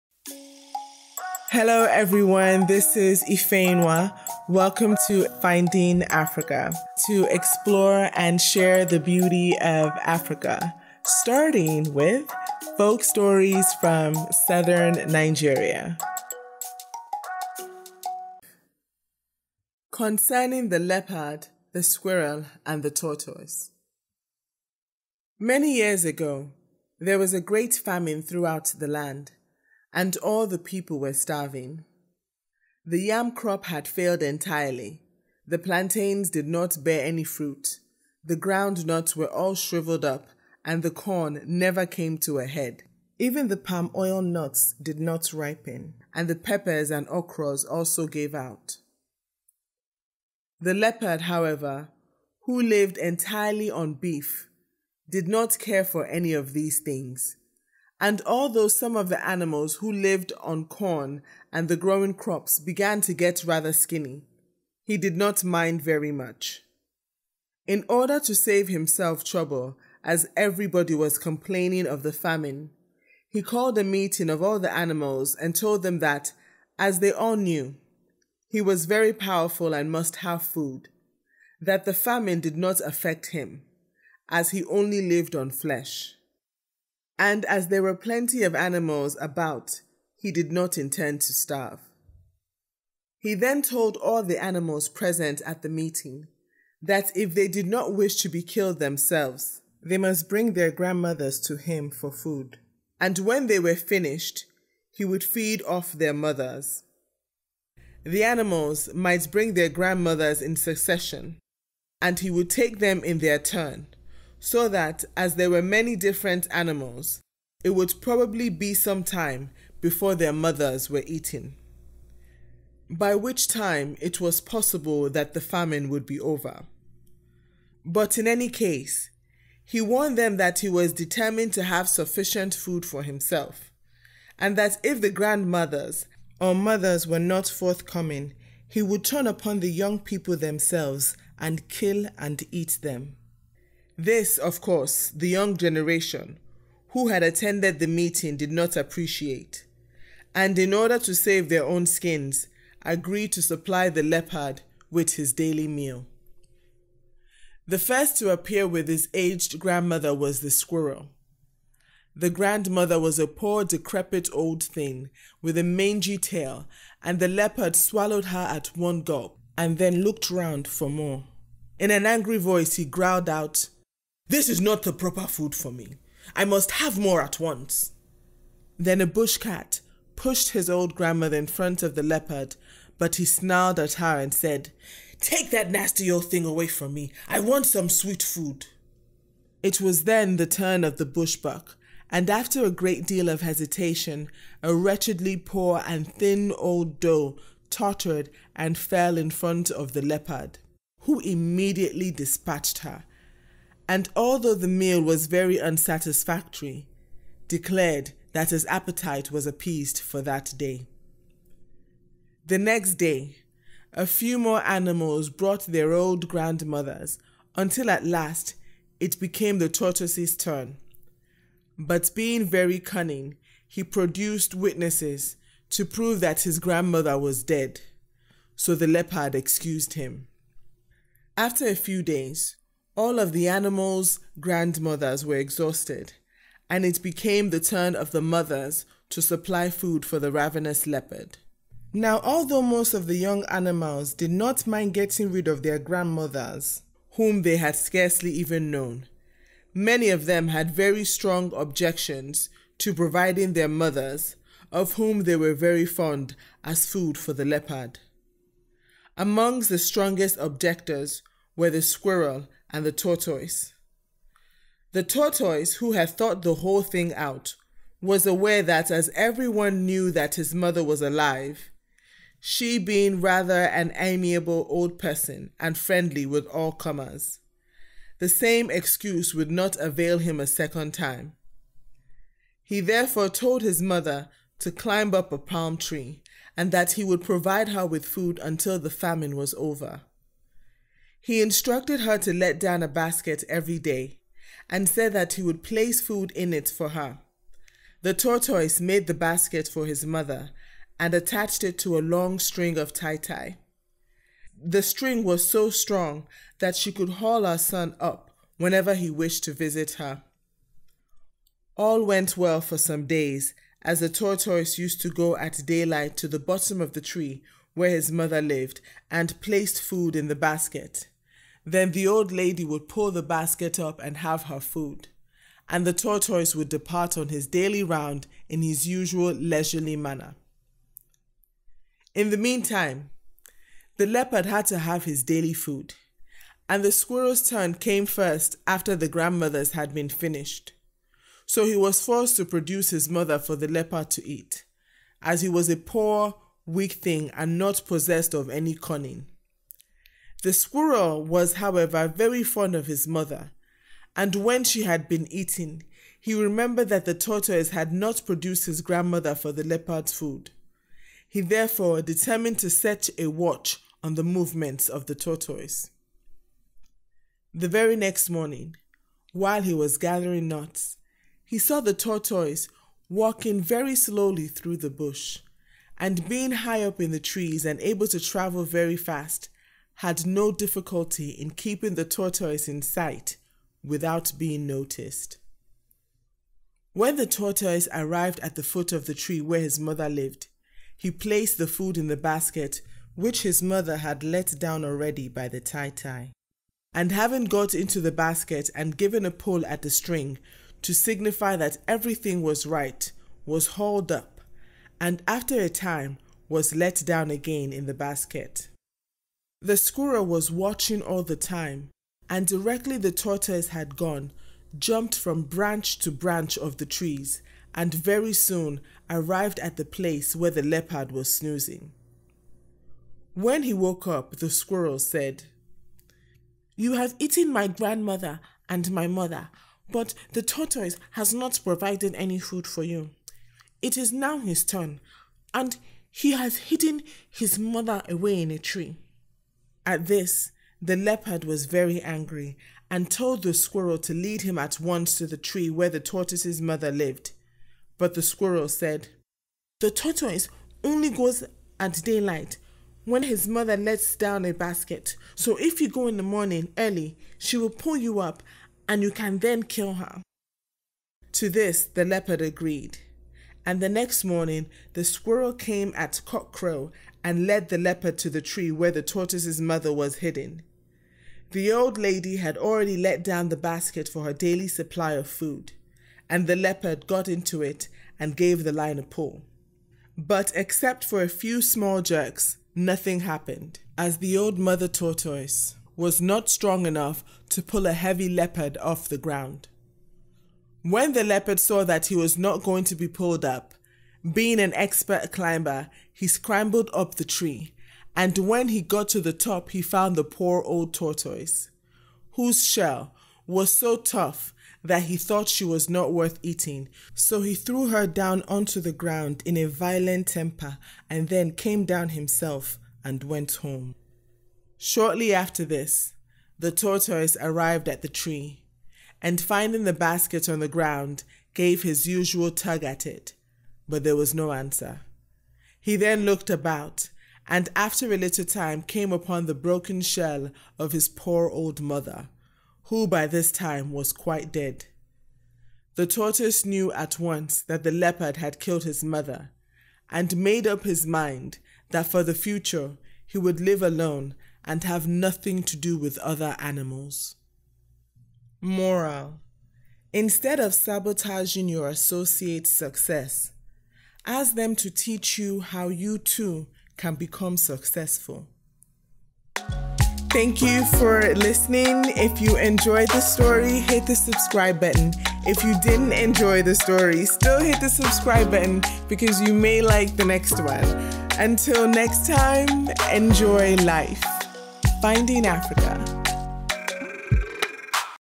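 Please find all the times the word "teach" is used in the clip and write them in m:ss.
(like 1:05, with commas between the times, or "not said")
9:14.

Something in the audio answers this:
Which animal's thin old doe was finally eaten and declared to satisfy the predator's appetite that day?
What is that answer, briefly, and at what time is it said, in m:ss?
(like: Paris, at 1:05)
bush buck, at 3:11.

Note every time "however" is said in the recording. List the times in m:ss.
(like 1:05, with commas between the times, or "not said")
0:51, 5:51.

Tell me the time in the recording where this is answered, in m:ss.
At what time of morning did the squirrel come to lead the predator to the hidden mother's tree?
7:46.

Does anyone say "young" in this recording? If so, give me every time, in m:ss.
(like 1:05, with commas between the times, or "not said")
2:19, 2:25, 4:03.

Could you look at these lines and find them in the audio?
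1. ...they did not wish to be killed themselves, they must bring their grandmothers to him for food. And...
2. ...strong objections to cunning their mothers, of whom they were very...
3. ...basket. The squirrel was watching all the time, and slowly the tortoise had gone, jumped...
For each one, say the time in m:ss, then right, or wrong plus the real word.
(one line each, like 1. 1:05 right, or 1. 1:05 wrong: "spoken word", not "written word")
1. 1:37 right
2. 4:11 wrong: "providing", not "cunning"
3. 6:47 wrong: "directly", not "slowly".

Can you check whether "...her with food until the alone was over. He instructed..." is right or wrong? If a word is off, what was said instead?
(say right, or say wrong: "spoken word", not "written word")
wrong: "famine", not "alone".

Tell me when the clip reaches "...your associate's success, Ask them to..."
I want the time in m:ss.
9:11.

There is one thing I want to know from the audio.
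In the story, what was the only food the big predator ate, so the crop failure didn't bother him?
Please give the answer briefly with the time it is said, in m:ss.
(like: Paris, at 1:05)
beef, at 0:53.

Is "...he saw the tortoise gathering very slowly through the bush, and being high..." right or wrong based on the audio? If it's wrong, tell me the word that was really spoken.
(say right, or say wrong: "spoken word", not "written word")
wrong: "walking", not "gathering".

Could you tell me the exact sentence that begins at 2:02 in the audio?
By which time it was possible that the famine would be over.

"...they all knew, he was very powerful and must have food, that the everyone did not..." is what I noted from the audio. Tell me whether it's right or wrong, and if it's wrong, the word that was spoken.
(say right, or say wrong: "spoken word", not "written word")
wrong: "famine", not "everyone".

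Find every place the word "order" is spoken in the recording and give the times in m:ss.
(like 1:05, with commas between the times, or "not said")
1:07, 2:30.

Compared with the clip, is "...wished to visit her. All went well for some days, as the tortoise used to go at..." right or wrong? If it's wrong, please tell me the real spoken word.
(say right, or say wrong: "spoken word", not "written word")
right.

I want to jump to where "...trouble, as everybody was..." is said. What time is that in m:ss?
1:09.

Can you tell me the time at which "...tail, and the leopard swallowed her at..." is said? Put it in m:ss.
2:46.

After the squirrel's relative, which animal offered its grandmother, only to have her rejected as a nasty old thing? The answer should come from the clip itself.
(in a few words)
bush cat.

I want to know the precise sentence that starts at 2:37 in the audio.
The first to appear with his aged grandmother was the squirrel.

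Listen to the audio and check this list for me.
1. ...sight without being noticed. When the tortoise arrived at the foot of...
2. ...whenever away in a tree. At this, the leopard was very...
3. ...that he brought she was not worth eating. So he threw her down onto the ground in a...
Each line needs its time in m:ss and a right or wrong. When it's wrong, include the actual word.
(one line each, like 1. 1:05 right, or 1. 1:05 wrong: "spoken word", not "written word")
1. 6:22 right
2. 7:17 wrong: "mother", not "whenever"
3. 8:24 wrong: "thought", not "brought".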